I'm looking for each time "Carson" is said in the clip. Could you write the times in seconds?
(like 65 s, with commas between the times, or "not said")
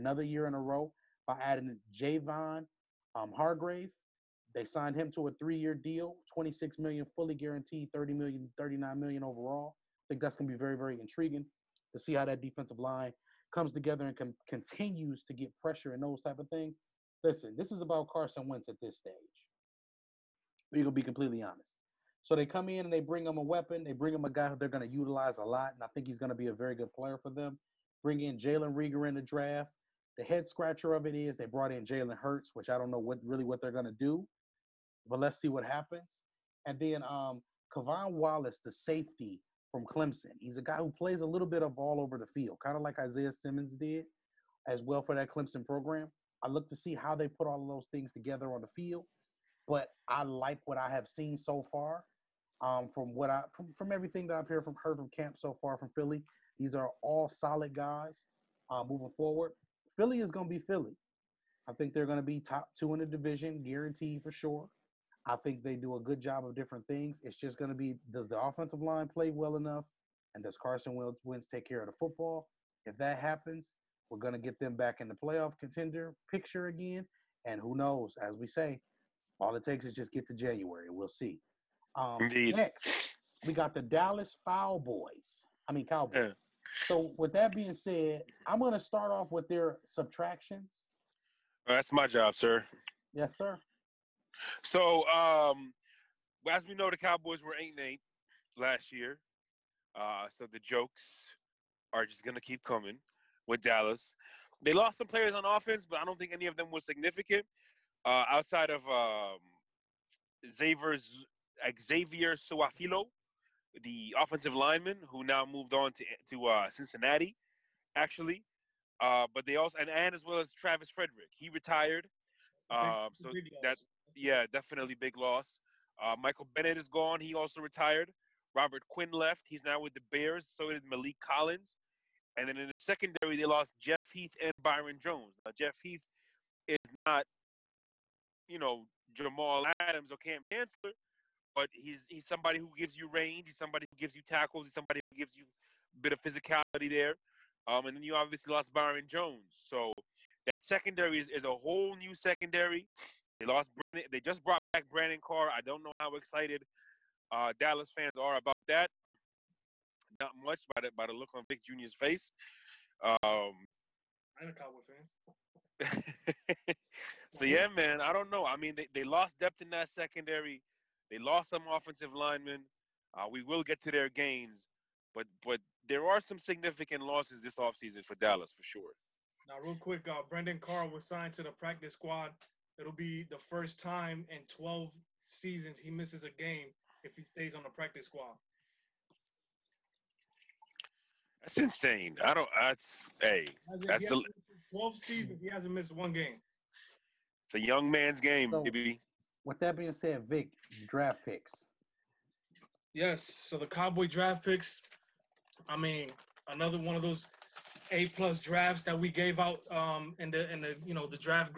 18 s, 70 s.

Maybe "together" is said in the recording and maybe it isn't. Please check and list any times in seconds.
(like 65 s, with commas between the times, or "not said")
13 s, 48 s.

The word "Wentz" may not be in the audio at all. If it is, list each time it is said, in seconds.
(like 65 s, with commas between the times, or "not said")
18 s, 71 s.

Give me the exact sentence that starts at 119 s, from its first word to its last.
Uh, but they also and, and as well as Travis Frederick, he retired.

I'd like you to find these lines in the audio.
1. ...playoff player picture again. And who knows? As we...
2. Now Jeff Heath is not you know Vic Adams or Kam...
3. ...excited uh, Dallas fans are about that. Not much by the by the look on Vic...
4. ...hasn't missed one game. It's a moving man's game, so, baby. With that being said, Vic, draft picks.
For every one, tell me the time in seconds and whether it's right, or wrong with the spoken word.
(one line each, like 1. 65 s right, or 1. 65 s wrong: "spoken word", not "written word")
1. 75 s wrong: "contender", not "player"
2. 135 s wrong: "Jamal", not "Vic"
3. 156 s right
4. 195 s wrong: "young", not "moving".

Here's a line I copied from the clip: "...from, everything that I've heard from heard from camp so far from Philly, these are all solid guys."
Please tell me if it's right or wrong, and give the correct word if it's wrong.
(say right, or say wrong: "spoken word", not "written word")
right.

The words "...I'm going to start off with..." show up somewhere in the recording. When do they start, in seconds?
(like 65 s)
88 s.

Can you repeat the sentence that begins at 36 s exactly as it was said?
And then um, K'Von Wallace, the safety from Clemson.